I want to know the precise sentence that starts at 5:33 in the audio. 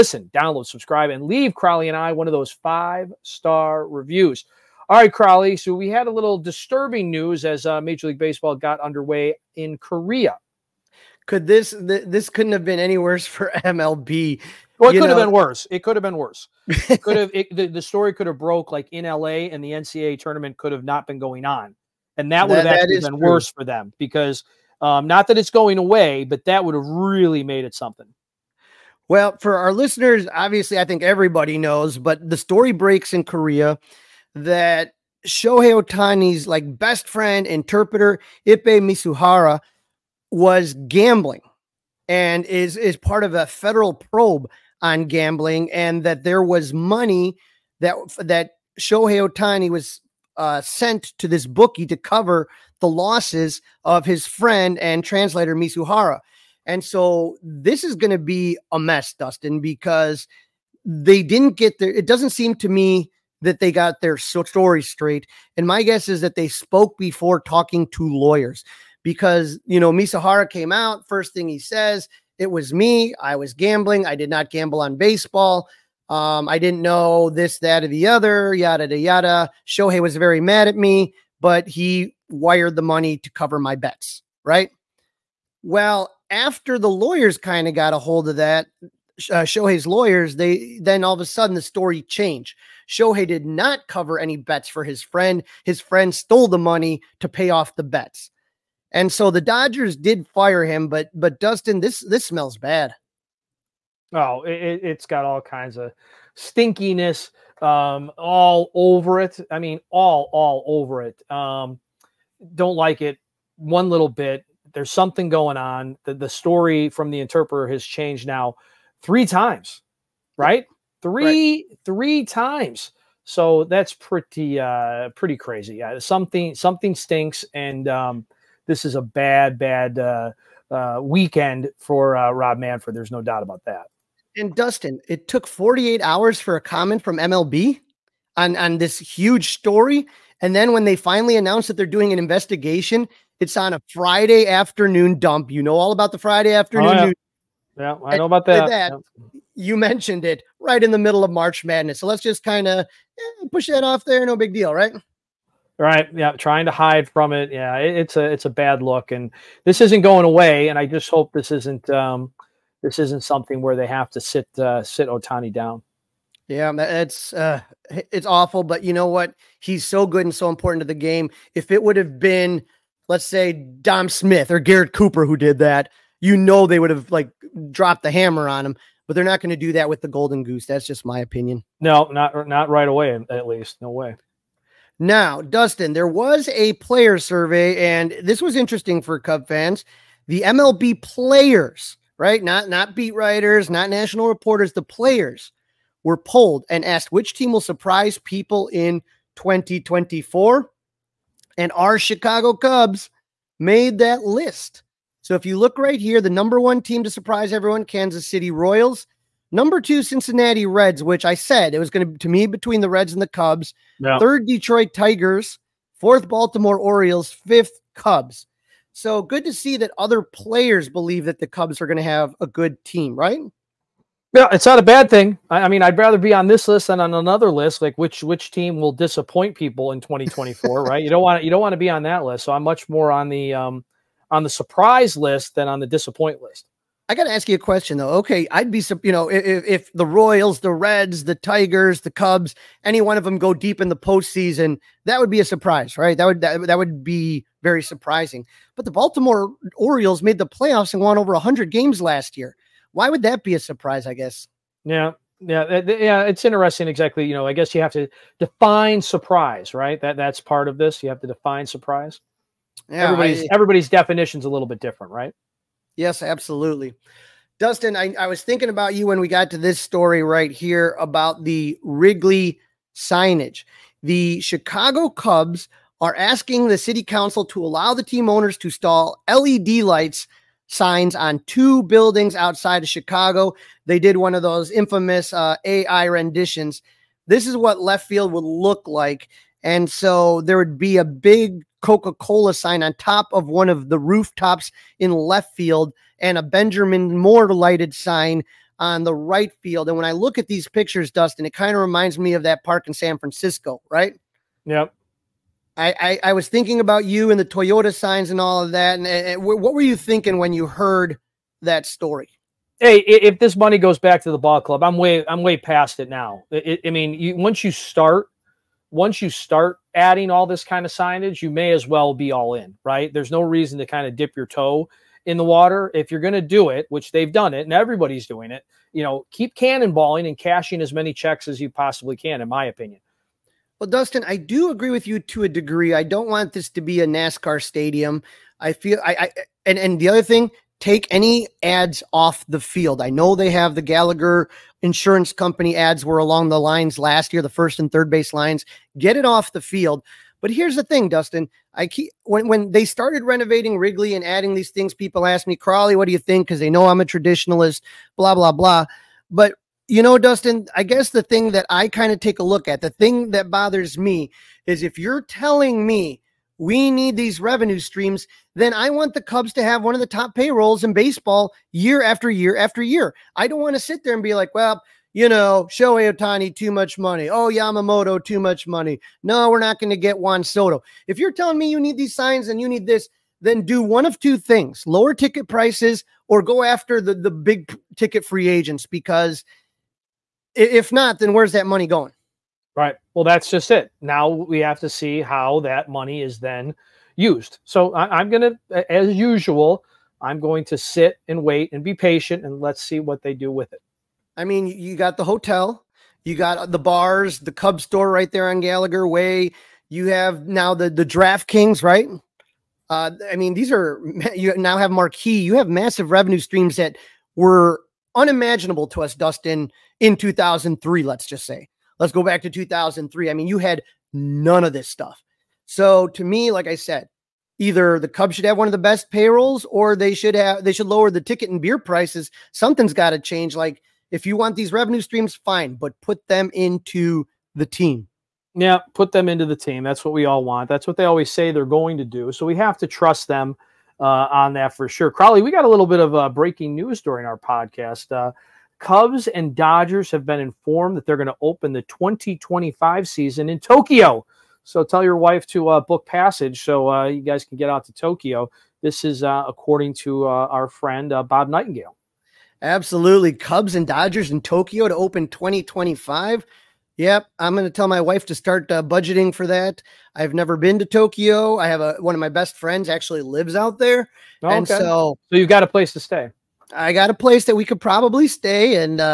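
Well, Dustin, I do agree with you to a degree.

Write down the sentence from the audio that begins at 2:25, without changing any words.
You know all about the Friday afternoon.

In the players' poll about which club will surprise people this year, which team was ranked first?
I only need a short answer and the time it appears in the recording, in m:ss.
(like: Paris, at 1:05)
Kansas City Royals, at 3:27.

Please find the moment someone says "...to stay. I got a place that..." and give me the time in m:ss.
7:55.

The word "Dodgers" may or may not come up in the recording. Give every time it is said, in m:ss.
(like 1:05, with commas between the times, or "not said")
1:39, 7:29, 7:43.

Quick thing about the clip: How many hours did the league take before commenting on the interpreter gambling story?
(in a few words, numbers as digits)
48.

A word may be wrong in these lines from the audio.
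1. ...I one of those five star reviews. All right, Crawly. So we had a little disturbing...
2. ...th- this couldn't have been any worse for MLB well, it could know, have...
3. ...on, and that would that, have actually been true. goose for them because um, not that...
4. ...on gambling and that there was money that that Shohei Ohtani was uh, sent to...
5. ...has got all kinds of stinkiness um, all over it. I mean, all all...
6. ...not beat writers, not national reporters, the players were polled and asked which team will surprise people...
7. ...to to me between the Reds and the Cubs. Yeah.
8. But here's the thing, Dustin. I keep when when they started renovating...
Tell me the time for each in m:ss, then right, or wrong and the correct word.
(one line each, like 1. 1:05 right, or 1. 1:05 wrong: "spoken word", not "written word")
1. 0:01 right
2. 0:11 right
3. 0:21 wrong: "worse", not "goose"
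4. 0:44 right
5. 1:44 right
6. 3:12 right
7. 3:32 right
8. 5:50 right.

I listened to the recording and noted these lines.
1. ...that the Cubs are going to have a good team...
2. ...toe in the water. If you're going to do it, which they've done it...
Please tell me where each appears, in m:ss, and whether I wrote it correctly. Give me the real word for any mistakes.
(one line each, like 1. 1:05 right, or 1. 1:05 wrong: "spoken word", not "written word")
1. 3:41 right
2. 5:24 right.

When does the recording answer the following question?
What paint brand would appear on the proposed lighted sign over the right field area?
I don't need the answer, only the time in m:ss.
4:56.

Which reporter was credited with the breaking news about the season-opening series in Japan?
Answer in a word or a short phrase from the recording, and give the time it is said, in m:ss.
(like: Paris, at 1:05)
Bob Nightingale, at 7:41.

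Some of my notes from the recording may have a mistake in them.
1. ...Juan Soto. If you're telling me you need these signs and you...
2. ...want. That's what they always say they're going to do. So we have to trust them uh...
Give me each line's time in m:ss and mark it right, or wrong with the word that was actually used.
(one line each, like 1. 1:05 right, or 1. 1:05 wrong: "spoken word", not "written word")
1. 6:20 right
2. 7:20 right.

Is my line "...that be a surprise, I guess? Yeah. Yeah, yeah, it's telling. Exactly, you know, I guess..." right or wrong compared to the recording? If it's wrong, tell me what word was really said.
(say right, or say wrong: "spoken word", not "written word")
wrong: "interesting", not "telling".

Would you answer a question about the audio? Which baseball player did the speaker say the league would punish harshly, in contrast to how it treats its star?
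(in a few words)
Dom Smith.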